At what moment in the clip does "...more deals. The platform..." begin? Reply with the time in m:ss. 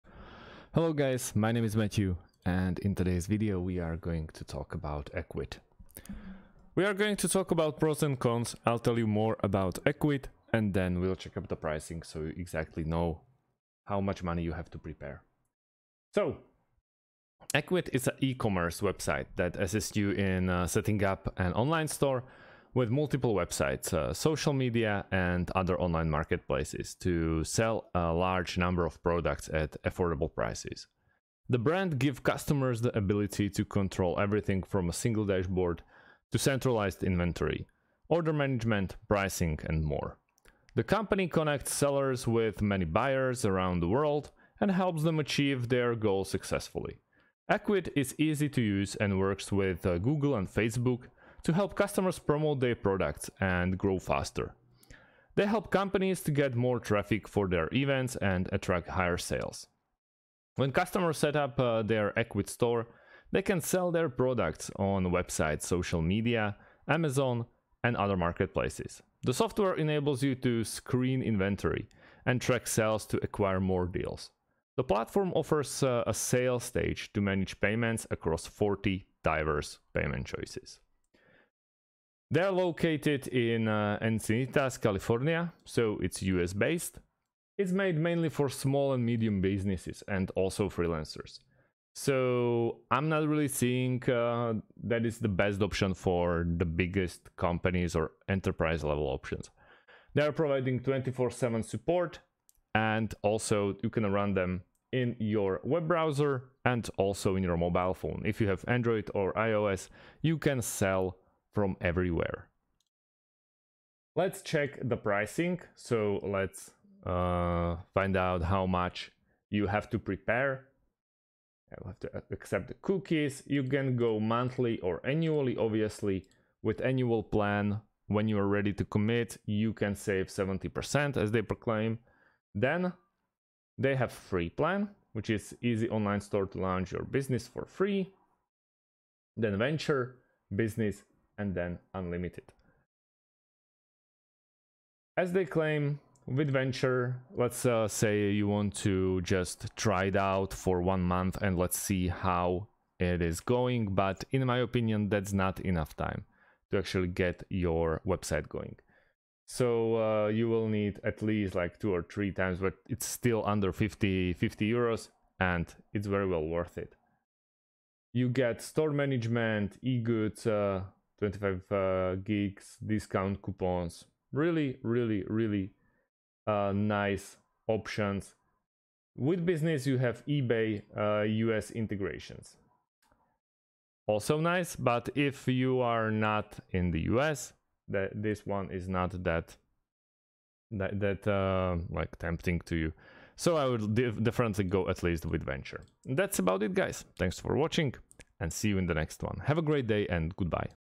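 1:13.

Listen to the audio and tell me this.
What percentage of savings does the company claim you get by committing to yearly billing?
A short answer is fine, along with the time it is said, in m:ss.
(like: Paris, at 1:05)
70%, at 2:10.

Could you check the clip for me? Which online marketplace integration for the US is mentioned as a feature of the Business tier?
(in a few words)
eBay.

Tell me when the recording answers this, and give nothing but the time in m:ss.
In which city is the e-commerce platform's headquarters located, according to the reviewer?
1:24.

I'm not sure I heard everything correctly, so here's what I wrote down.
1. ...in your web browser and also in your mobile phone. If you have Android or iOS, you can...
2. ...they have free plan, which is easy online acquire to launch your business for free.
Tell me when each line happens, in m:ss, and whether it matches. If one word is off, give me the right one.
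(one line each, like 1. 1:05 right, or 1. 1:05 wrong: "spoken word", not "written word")
1. 1:44 right
2. 2:13 wrong: "store", not "acquire".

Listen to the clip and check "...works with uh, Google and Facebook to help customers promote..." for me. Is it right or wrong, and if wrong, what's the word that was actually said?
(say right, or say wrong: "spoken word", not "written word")
right.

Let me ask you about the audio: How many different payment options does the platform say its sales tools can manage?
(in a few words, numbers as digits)
40.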